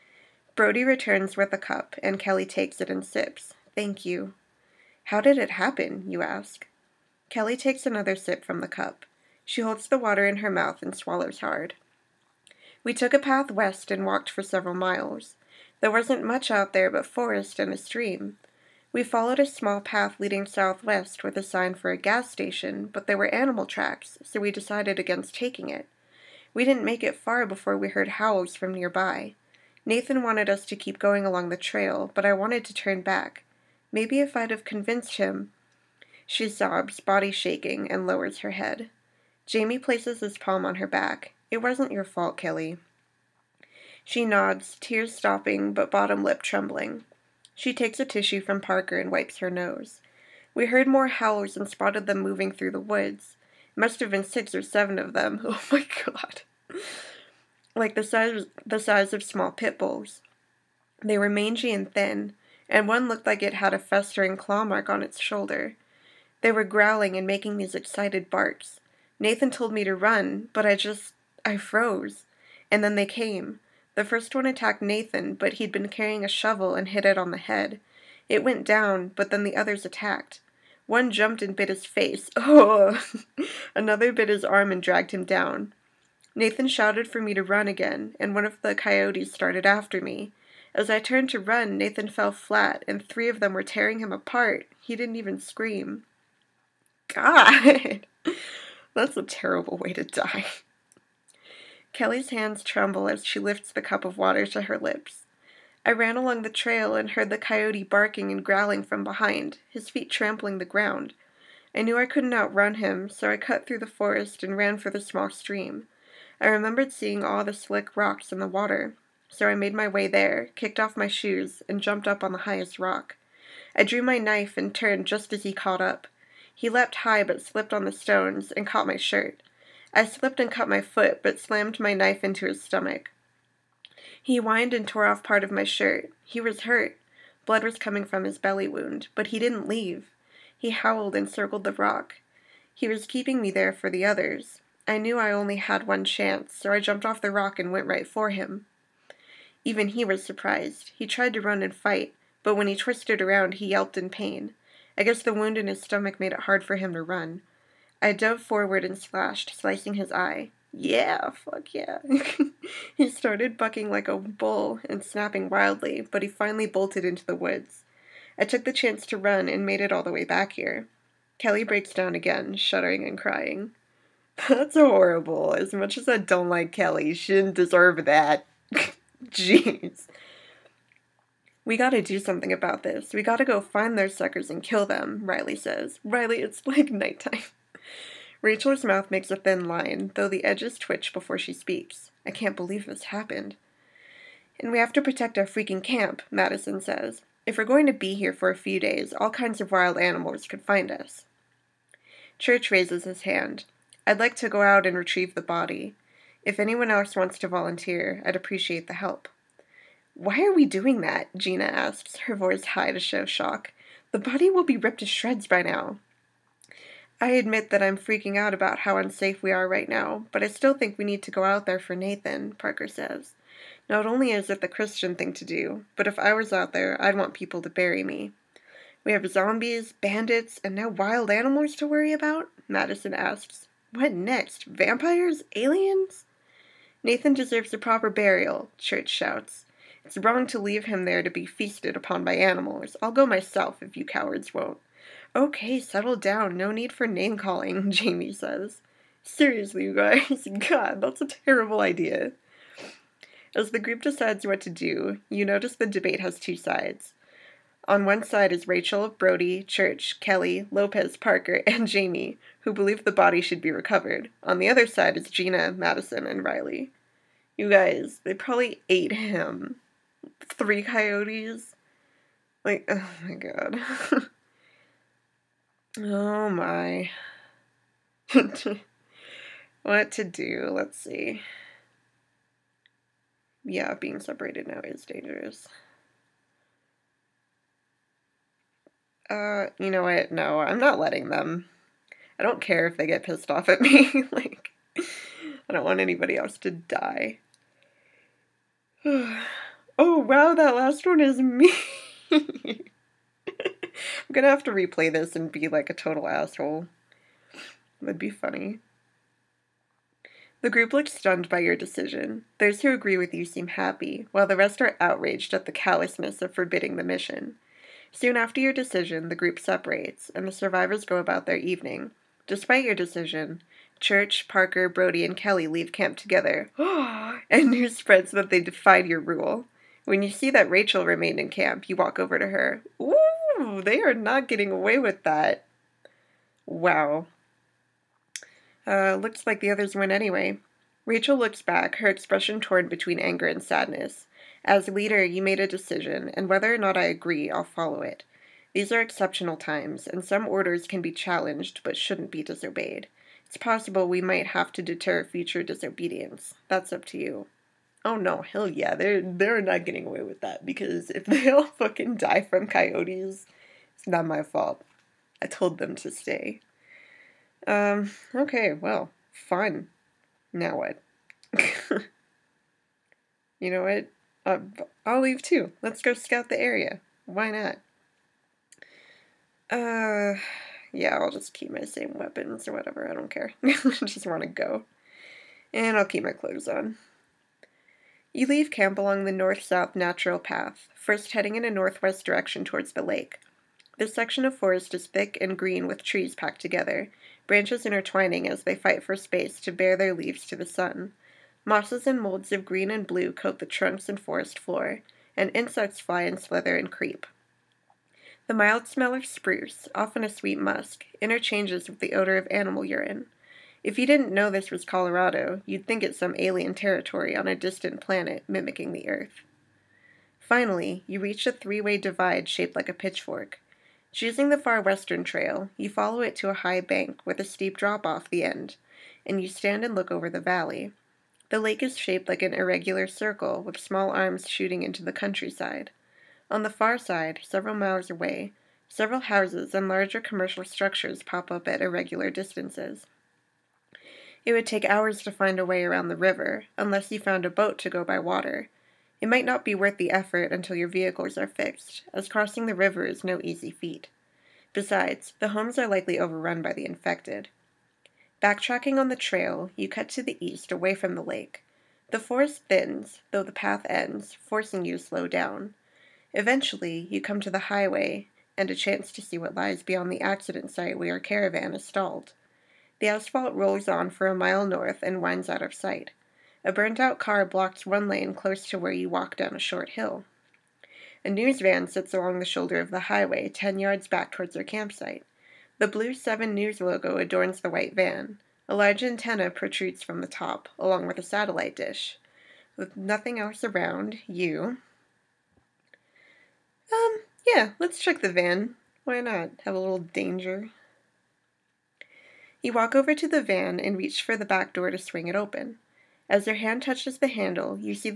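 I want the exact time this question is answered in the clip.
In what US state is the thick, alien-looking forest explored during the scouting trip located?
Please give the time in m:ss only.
6:54.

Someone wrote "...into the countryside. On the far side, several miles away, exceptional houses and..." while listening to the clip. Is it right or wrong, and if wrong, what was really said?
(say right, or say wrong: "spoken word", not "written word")
wrong: "several", not "exceptional".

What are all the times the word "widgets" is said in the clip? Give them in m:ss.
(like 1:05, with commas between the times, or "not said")
not said.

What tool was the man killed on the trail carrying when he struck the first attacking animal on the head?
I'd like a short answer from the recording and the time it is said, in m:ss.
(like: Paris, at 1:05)
shovel, at 1:16.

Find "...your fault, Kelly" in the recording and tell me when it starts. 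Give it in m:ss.
0:41.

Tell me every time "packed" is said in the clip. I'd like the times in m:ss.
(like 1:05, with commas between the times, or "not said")
6:36.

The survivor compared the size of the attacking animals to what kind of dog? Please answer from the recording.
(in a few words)
small pit bulls.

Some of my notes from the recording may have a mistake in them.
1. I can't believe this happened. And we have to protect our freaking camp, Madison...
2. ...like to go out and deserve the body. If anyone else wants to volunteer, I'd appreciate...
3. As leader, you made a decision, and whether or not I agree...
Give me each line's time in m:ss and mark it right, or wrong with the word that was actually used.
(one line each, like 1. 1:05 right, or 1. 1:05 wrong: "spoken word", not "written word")
1. 3:12 right
2. 3:24 wrong: "retrieve", not "deserve"
3. 5:44 right.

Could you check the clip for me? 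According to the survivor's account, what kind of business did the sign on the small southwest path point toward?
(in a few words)
gas station.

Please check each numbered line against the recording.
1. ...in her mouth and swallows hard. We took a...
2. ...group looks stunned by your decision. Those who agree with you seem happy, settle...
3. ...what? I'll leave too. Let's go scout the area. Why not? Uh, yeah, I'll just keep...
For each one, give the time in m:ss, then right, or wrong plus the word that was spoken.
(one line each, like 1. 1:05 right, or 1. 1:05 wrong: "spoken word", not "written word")
1. 0:10 right
2. 5:10 wrong: "while", not "settle"
3. 6:13 right.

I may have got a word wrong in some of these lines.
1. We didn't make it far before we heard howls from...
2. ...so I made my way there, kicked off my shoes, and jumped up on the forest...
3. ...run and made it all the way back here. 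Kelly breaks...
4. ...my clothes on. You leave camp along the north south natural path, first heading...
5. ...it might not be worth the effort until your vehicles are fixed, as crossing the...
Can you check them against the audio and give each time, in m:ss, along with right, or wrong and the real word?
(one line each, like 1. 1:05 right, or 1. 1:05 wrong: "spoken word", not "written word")
1. 0:26 right
2. 1:59 wrong: "highest", not "forest"
3. 2:49 right
4. 6:26 right
5. 7:29 right.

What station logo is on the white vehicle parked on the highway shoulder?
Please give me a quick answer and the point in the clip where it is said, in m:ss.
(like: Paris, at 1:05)
7 News, at 8:06.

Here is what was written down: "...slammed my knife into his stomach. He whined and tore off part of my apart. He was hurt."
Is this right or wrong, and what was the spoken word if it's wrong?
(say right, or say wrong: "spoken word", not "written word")
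wrong: "shirt", not "apart".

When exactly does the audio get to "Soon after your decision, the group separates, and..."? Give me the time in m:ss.
5:18.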